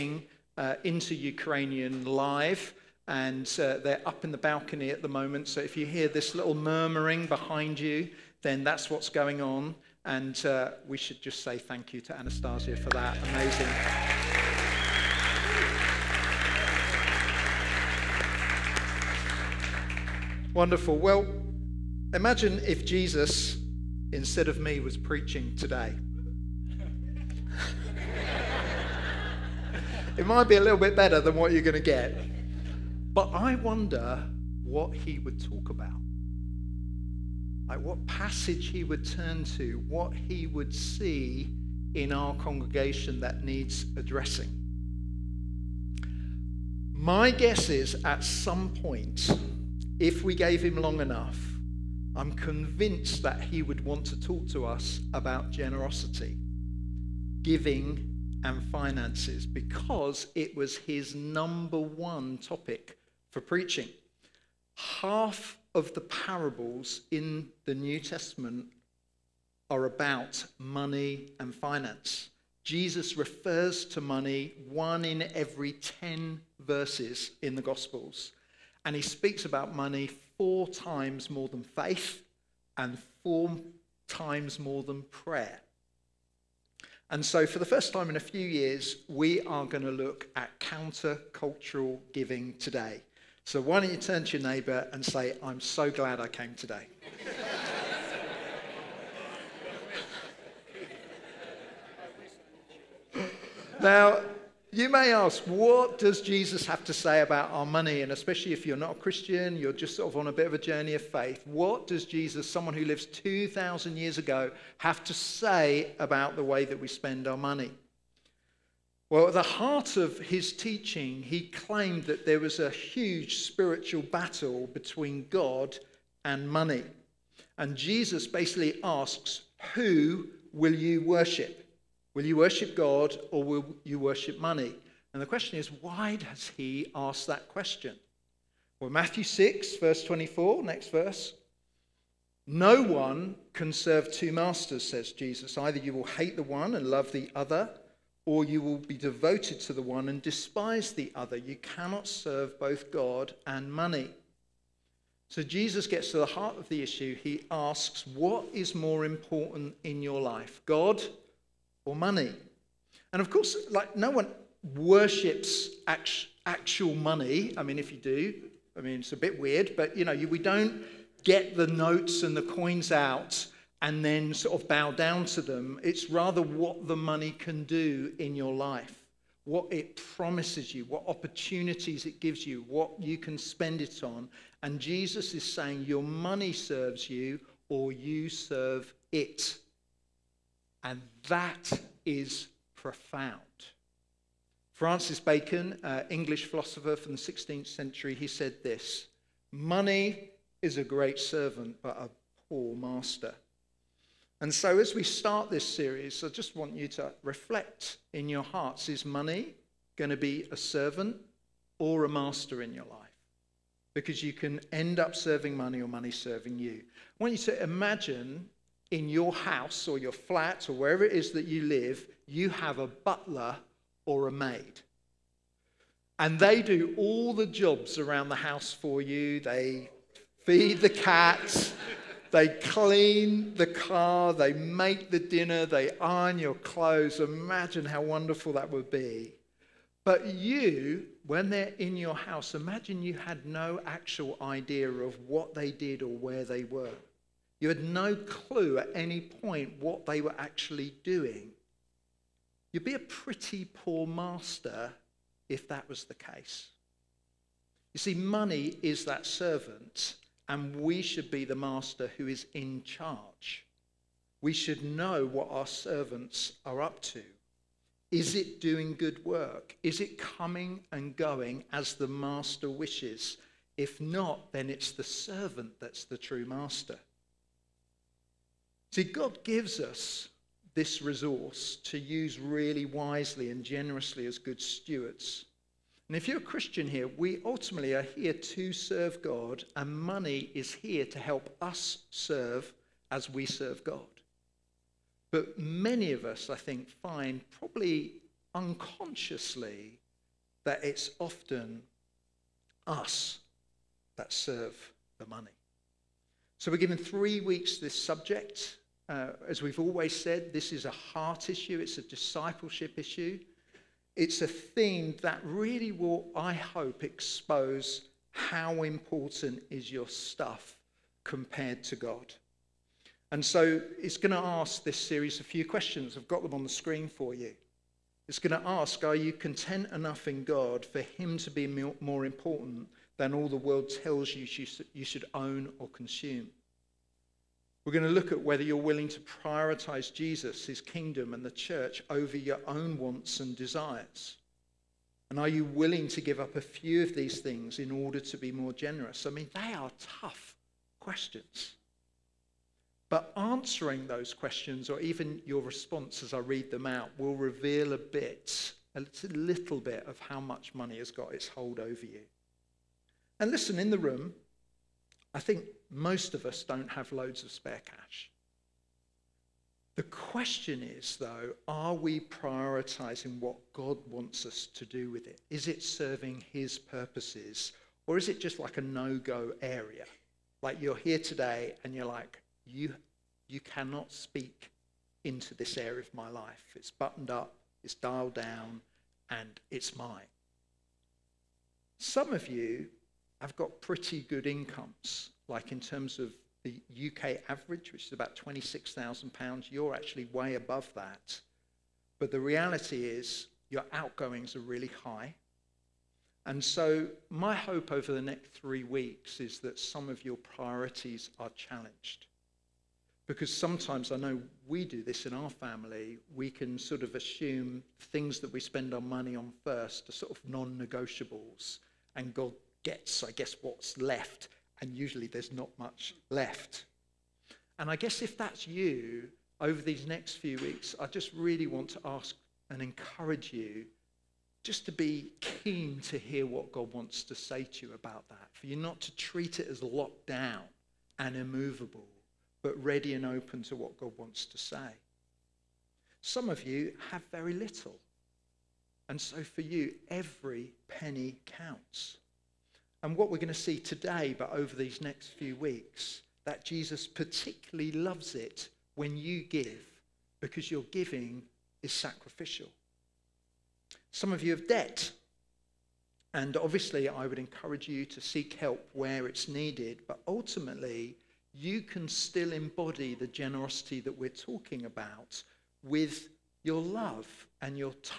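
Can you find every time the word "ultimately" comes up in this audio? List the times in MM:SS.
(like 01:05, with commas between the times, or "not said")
04:47, 07:50.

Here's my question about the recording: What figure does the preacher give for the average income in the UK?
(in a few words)
£26,000.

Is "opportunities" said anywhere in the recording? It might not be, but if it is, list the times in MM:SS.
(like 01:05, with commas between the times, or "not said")
03:01.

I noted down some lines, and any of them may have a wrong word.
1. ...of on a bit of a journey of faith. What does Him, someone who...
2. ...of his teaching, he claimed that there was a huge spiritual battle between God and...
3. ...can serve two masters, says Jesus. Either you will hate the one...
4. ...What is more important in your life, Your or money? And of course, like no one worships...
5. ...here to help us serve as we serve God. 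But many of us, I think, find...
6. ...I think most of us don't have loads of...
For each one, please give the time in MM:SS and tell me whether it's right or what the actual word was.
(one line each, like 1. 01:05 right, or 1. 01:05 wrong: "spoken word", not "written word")
1. 01:50 wrong: "Jesus", not "Him"
2. 01:59 right
3. 02:23 right
4. 02:38 wrong: "God", not "Your"
5. 04:50 right
6. 06:05 right.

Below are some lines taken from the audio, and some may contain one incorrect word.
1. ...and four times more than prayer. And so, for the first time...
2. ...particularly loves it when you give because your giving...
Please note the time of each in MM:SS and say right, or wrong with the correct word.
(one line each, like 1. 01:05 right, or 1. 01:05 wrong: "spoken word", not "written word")
1. 01:22 right
2. 07:37 right.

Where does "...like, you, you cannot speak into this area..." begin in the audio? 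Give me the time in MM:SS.
06:22.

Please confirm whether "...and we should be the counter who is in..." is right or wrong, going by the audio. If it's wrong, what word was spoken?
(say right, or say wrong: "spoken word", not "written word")
wrong: "master", not "counter".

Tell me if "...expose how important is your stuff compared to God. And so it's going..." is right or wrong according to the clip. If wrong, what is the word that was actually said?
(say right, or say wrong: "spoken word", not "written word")
right.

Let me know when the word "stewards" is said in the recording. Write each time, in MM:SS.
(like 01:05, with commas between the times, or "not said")
04:44.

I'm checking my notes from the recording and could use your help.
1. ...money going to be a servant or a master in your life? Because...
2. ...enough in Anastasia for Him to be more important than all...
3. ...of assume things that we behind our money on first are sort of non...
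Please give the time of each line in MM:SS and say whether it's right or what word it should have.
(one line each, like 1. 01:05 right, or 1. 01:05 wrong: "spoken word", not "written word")
1. 03:29 right
2. 05:29 wrong: "God", not "Anastasia"
3. 06:57 wrong: "spend", not "behind".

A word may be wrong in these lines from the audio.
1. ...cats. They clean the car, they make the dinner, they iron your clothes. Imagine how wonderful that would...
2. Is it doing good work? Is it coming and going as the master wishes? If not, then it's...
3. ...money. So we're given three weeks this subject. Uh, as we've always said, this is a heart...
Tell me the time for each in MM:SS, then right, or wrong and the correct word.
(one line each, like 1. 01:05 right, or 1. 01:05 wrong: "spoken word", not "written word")
1. 03:50 right
2. 04:28 right
3. 05:05 right.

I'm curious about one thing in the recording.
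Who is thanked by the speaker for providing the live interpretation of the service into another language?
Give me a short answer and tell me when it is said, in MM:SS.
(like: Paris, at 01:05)
Anastasia, at 00:12.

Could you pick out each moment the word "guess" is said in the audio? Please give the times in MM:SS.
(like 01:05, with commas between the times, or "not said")
00:47, 07:03, 07:07.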